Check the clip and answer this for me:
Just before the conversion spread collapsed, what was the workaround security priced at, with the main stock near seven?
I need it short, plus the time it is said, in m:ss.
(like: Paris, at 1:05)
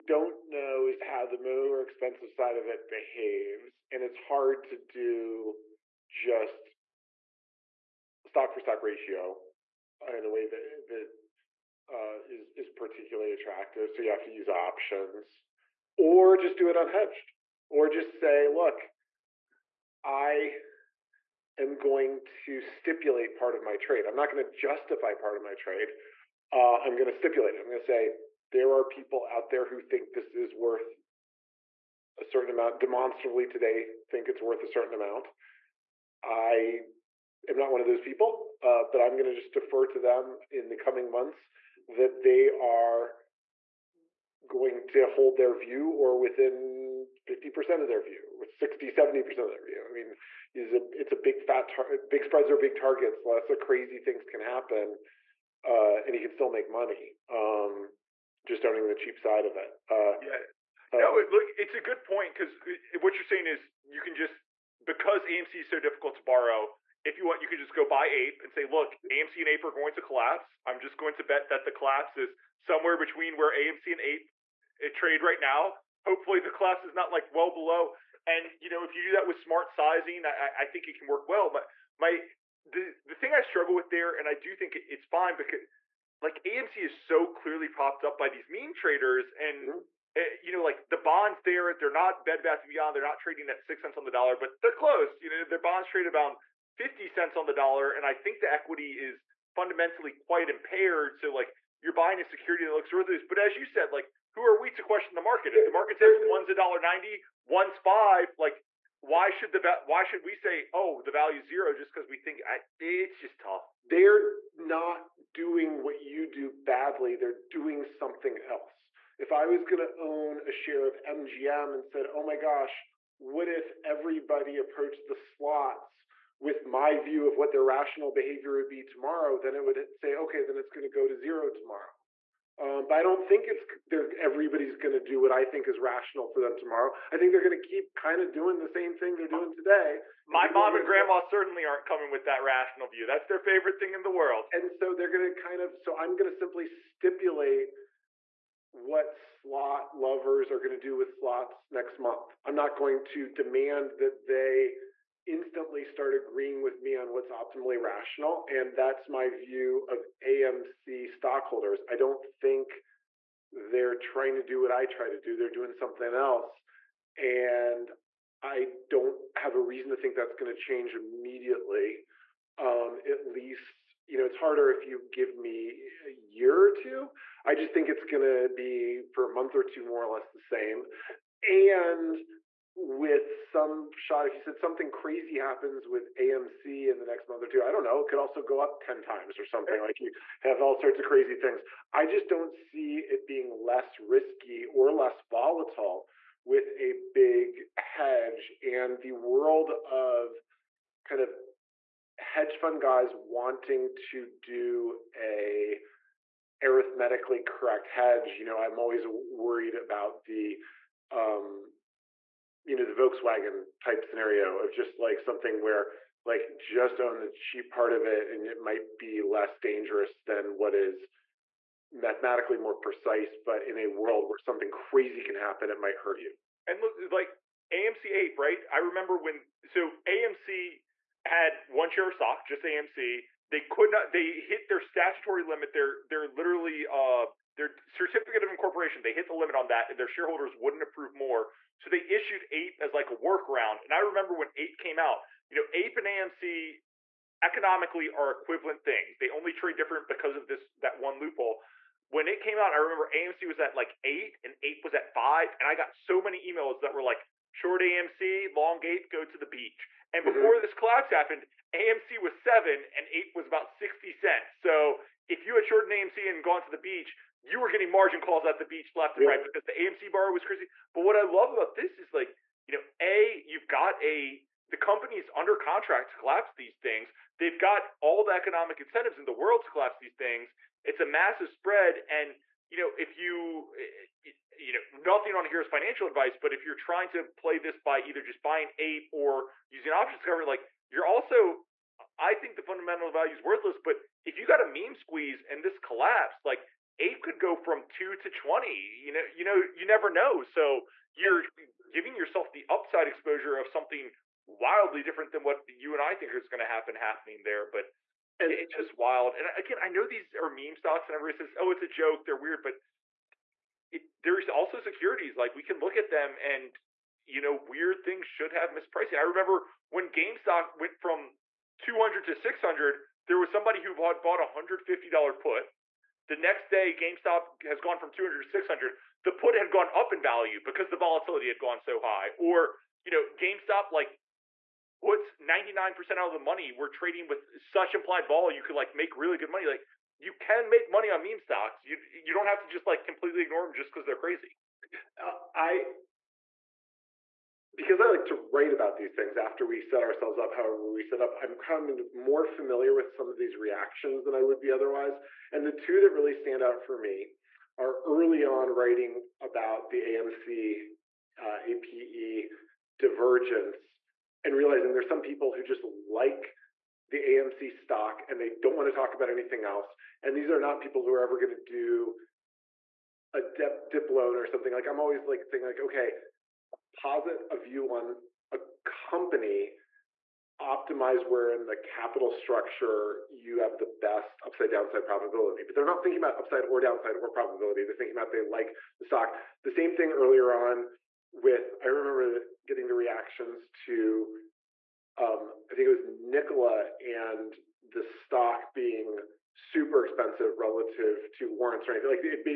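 60 cents, at 4:23.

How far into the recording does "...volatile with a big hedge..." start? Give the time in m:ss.
3:15.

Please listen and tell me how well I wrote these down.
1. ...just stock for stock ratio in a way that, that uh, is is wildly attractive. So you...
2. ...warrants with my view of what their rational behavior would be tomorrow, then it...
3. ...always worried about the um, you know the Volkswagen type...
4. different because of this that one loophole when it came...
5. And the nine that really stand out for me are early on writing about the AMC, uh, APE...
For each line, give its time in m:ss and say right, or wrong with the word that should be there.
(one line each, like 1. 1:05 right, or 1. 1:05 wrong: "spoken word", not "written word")
1. 0:06 wrong: "particularly", not "wildly"
2. 2:05 wrong: "slots", not "warrants"
3. 3:28 right
4. 4:09 right
5. 5:55 wrong: "two", not "nine".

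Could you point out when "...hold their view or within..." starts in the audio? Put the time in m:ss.
0:45.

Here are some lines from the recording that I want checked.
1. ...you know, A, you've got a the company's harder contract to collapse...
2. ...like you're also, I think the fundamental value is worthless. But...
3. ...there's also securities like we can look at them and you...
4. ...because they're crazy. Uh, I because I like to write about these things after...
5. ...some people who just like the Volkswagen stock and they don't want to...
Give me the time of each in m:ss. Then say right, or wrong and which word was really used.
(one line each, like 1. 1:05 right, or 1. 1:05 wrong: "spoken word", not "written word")
1. 4:32 wrong: "under", not "harder"
2. 4:50 right
3. 5:14 right
4. 5:43 right
5. 6:05 wrong: "AMC", not "Volkswagen".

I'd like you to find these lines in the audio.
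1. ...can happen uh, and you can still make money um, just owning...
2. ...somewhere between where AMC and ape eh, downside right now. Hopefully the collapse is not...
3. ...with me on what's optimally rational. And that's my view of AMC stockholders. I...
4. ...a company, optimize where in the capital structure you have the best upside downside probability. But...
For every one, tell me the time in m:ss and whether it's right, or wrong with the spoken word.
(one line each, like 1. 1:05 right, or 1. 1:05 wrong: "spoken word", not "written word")
1. 0:54 right
2. 1:12 wrong: "trade", not "downside"
3. 2:36 right
4. 6:18 right.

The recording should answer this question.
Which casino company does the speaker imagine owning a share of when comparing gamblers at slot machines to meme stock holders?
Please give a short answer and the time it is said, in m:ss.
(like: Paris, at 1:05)
MGM, at 2:01.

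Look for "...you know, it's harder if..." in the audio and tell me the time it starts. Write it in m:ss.
2:54.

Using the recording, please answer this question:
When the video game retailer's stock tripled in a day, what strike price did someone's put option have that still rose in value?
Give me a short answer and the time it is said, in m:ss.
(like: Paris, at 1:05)
$150, at 5:24.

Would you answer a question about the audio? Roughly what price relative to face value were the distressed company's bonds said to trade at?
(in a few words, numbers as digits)
50 cents on the dollar.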